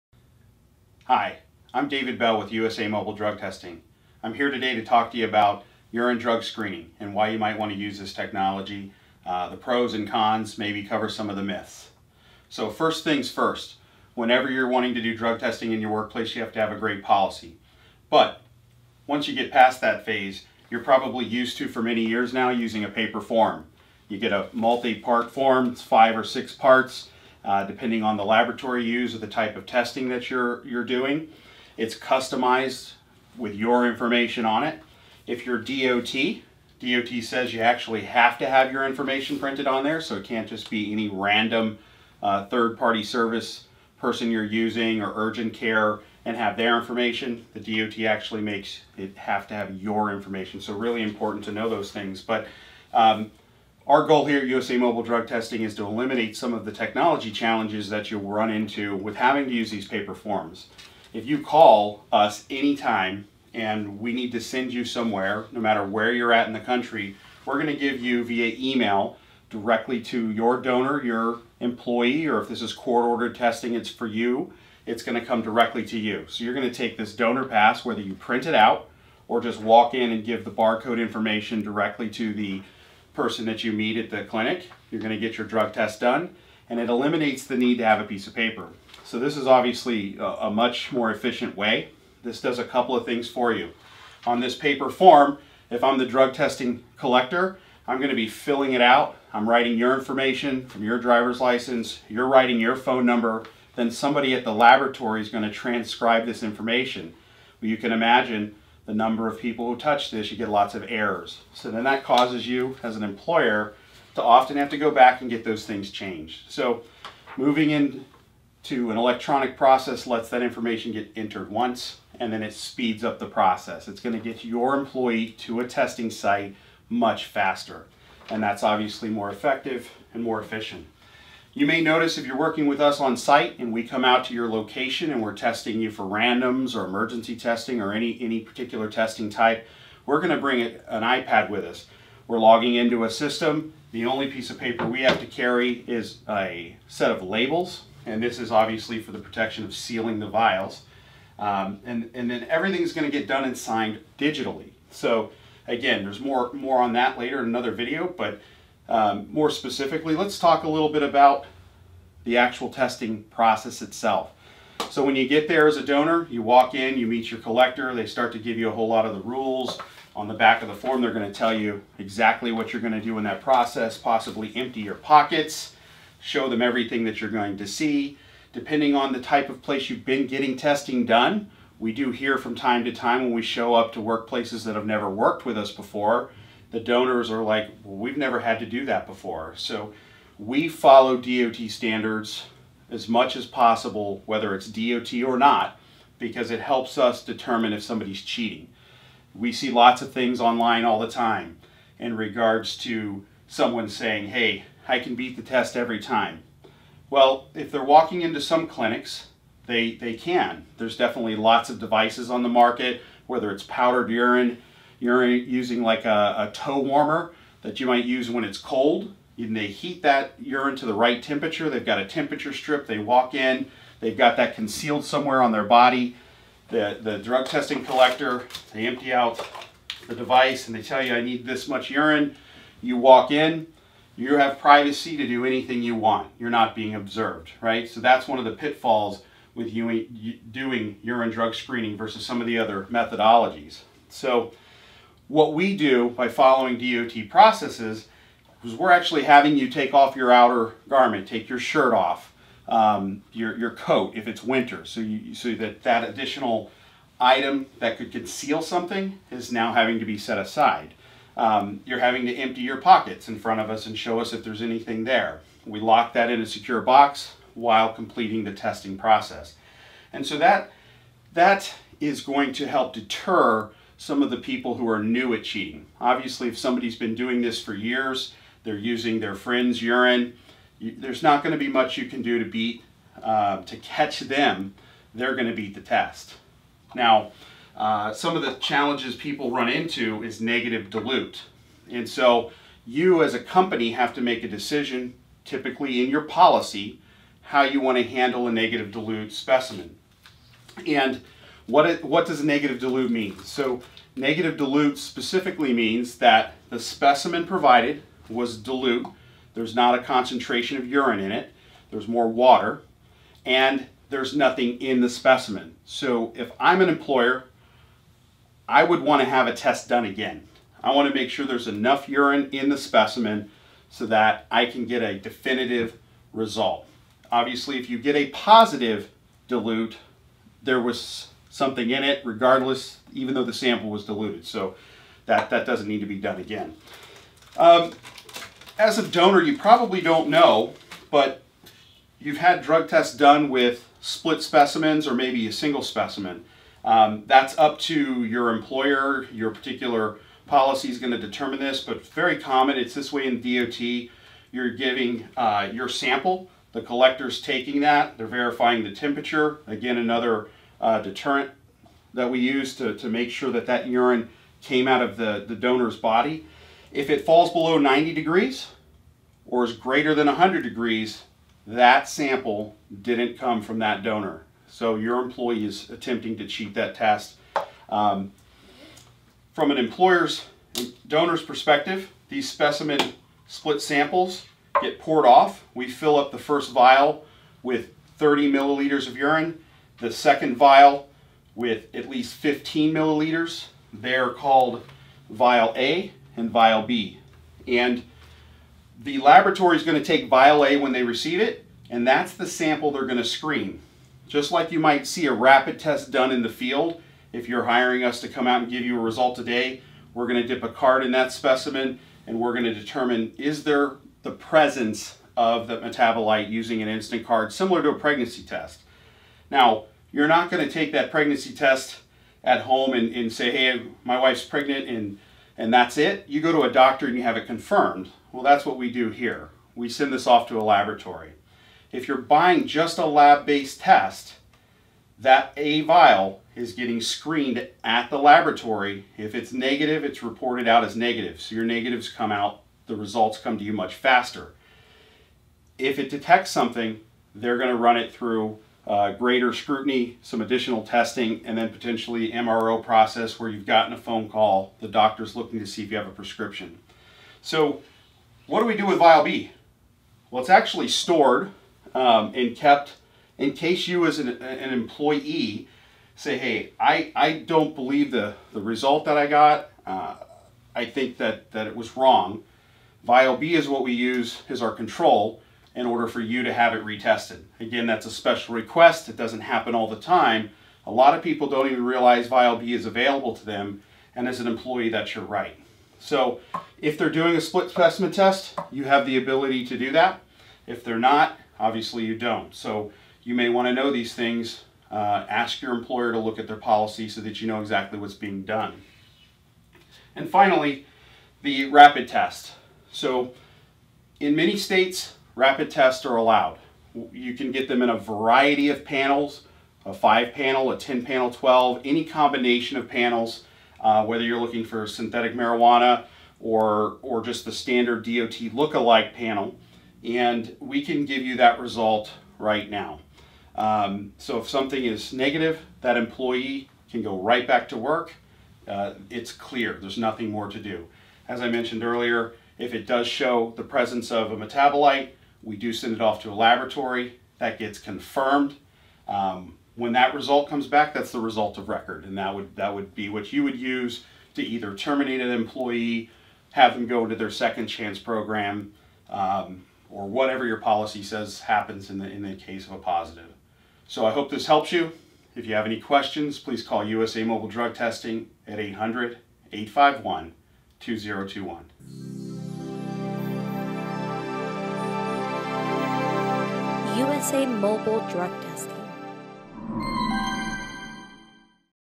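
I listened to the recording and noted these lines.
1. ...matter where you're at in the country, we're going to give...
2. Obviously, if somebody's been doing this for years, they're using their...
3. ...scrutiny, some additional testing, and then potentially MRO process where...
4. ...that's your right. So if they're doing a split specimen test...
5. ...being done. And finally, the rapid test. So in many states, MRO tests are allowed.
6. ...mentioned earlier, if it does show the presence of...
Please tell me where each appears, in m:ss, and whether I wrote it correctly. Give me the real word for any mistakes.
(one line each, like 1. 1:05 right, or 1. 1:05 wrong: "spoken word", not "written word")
1. 1:05 right
2. 4:36 right
3. 7:29 right
4. 8:04 right
5. 8:18 wrong: "Rapid", not "MRO"
6. 8:51 right.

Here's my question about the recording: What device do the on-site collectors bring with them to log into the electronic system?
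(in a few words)
iPad.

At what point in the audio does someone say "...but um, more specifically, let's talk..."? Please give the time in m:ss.
2:38.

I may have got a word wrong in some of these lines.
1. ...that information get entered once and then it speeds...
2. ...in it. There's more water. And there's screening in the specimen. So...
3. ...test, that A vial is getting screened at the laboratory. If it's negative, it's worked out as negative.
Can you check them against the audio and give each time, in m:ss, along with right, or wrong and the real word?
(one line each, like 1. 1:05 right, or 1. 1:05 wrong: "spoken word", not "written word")
1. 2:00 right
2. 5:11 wrong: "nothing", not "screening"
3. 7:13 wrong: "reported", not "worked".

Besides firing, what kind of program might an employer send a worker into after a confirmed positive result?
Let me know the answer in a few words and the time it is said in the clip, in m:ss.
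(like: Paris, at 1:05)
second chance program, at 9:07.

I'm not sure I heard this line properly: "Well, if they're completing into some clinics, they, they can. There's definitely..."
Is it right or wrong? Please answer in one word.
wrong.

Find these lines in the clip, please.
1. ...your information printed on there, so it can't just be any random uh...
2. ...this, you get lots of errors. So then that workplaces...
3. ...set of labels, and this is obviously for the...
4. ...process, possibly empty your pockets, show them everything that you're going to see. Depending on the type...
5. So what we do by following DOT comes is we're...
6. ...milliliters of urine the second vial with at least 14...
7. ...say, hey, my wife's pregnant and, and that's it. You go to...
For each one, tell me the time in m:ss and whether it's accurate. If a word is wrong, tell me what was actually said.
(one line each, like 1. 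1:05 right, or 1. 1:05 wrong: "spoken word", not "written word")
1. 0:38 right
2. 1:50 wrong: "causes", not "workplaces"
3. 2:26 right
4. 2:53 right
5. 4:04 wrong: "processes", not "comes"
6. 6:28 wrong: "15", not "14"
7. 7:03 right.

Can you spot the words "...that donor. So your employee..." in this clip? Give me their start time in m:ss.
6:13.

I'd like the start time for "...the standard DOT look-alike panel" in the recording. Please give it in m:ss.
8:37.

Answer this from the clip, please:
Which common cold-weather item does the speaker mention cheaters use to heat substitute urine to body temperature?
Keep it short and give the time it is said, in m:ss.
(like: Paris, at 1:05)
toe warmer, at 3:36.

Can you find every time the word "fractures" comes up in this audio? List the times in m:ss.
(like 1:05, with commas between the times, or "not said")
not said.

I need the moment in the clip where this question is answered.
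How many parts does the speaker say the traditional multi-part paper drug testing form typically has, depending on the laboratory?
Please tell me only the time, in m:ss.
0:25.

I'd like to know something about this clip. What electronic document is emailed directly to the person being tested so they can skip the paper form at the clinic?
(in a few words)
donor pass.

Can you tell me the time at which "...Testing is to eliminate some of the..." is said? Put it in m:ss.
0:55.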